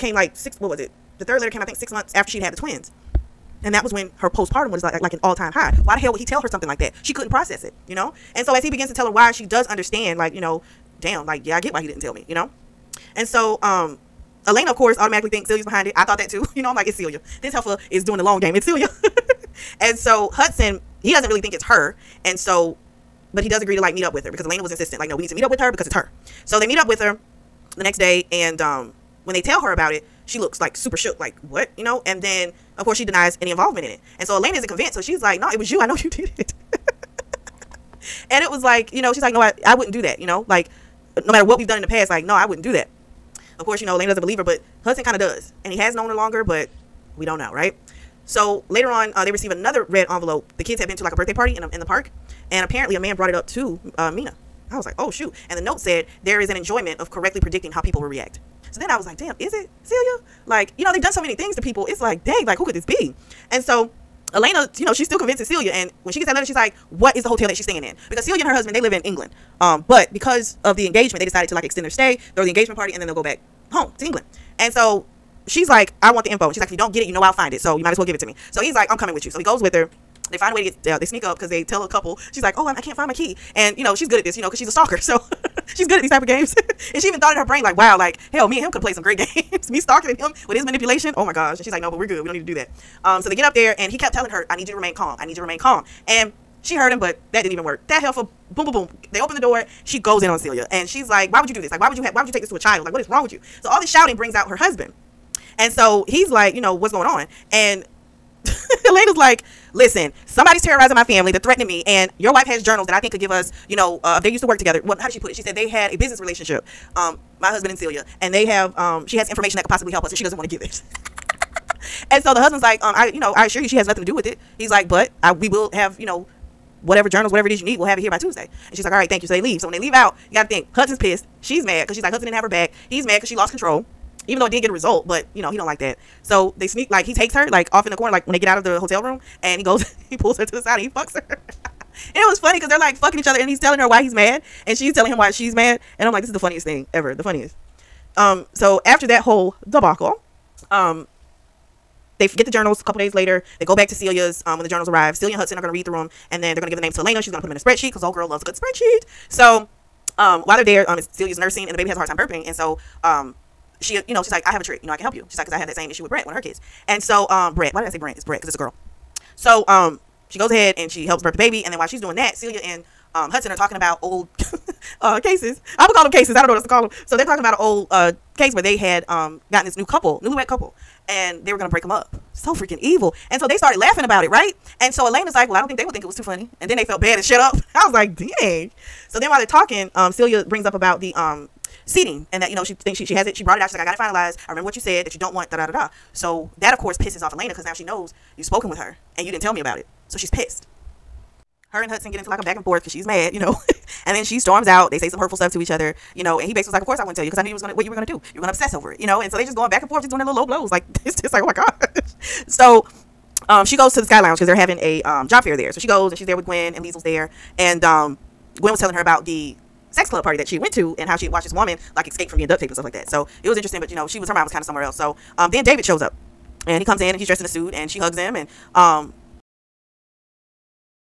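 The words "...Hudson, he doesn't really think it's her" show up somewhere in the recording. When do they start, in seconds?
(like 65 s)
20 s.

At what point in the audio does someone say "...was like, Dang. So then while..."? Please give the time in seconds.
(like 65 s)
187 s.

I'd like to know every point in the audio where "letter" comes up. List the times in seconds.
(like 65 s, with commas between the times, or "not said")
1 s, 66 s.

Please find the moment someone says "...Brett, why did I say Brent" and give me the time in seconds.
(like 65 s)
167 s.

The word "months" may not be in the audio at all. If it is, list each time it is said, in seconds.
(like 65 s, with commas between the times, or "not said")
1 s.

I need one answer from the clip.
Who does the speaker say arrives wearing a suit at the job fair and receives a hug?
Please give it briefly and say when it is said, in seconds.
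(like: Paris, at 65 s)
David, at 225 s.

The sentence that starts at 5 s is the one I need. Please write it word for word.
Why the hell would he tell her something like that?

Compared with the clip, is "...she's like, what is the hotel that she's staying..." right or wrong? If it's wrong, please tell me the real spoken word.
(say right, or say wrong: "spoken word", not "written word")
right.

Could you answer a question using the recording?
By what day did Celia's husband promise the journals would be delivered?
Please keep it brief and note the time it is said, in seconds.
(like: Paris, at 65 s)
Tuesday, at 128 s.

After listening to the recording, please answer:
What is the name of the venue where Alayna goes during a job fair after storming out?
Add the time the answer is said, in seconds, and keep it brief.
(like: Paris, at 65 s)
Sky Launch, at 214 s.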